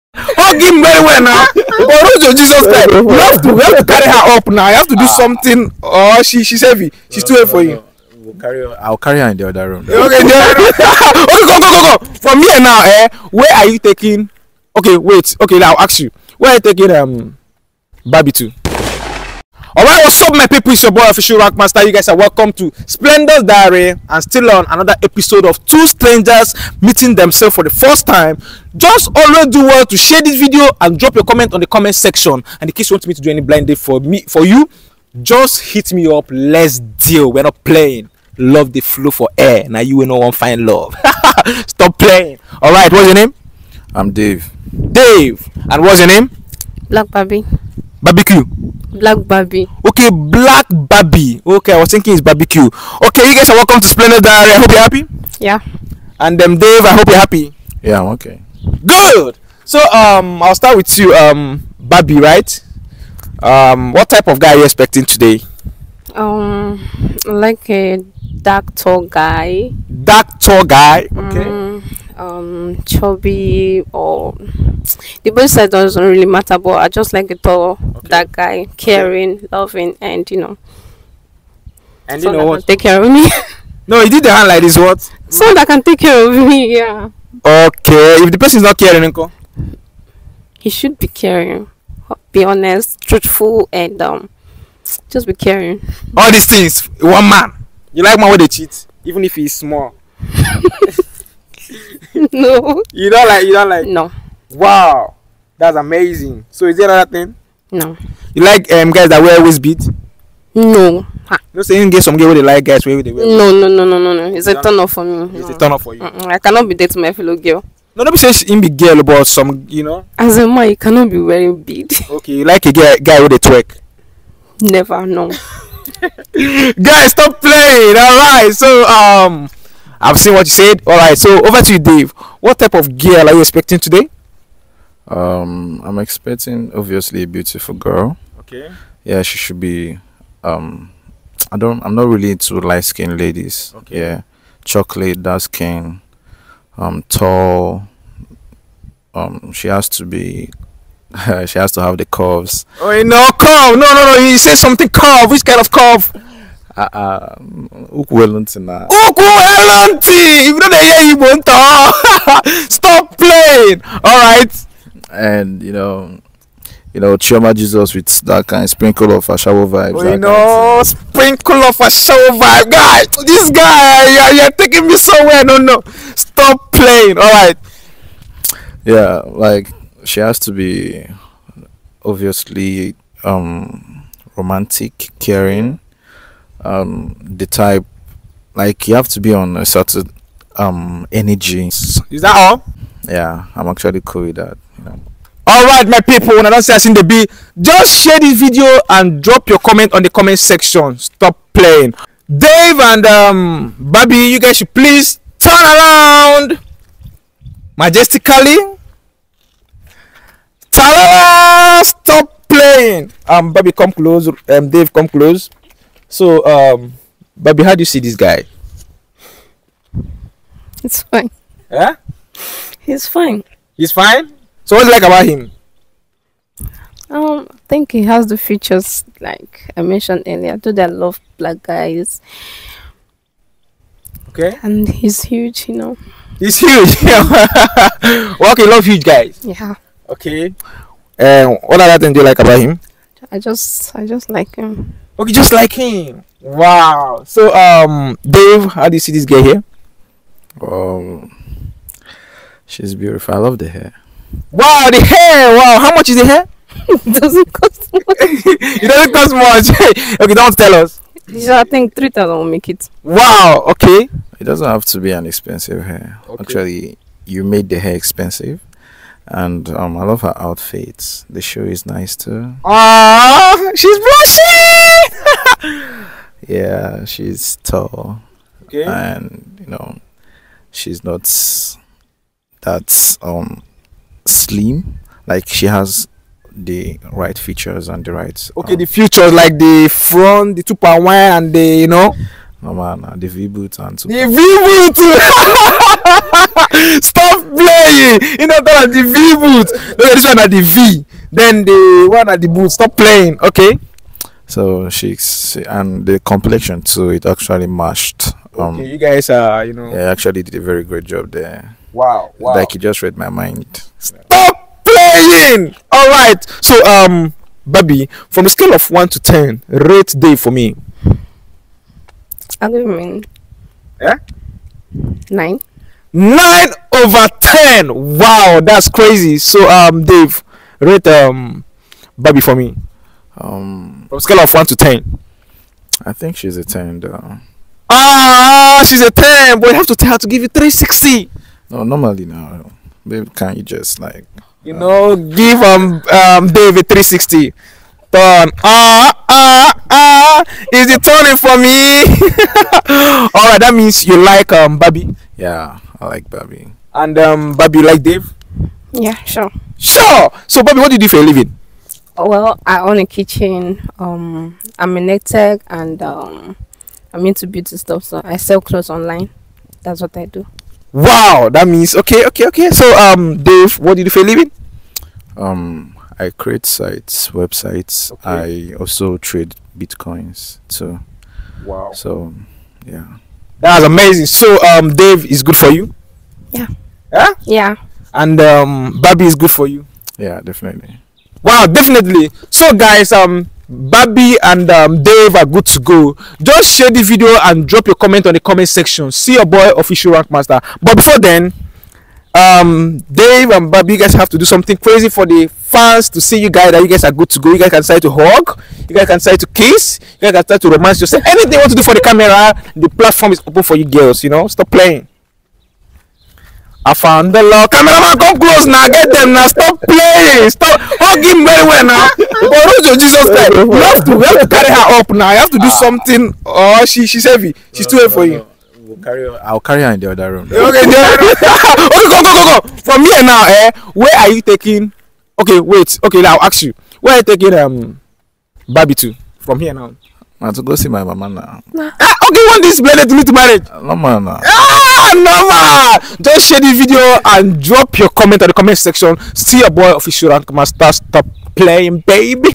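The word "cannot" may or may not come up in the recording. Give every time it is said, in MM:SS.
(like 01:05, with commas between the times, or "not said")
01:56, 02:00.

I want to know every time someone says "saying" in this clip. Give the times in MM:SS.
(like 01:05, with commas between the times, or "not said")
01:51, 01:58.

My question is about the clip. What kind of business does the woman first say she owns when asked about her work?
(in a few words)
A kitchen.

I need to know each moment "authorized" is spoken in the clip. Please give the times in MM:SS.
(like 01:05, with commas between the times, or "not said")
not said.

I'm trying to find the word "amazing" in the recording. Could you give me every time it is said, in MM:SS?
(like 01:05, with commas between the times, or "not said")
01:45, 06:23.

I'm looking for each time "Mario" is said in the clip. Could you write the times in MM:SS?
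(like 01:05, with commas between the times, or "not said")
not said.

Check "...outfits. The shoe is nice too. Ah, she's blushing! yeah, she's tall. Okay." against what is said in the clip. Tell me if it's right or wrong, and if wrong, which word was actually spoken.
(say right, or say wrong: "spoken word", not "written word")
right.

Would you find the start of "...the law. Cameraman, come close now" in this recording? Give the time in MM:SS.
06:57.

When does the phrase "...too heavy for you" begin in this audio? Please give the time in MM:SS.
00:07.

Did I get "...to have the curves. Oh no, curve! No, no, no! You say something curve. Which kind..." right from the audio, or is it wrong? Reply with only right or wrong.
right.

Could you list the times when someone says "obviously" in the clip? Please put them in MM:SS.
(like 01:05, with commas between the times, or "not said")
02:16, 03:02.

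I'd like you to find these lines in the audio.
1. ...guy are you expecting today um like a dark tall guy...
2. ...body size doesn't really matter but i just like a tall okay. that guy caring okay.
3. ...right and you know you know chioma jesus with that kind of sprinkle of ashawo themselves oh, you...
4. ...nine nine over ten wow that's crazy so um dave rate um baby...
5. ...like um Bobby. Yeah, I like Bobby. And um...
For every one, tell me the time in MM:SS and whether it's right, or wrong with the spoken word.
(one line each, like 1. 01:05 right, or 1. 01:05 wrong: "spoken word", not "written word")
1. 01:04 right
2. 01:15 right
3. 02:44 wrong: "vibes", not "themselves"
4. 05:25 right
5. 05:54 right.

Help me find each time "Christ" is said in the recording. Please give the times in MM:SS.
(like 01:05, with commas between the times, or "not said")
00:02, 07:03.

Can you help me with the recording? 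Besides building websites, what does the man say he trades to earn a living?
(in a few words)
Bitcoins.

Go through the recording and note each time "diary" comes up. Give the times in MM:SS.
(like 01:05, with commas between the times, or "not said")
00:23, 00:54.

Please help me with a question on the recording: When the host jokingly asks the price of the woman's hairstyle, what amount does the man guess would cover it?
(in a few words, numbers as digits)
3000.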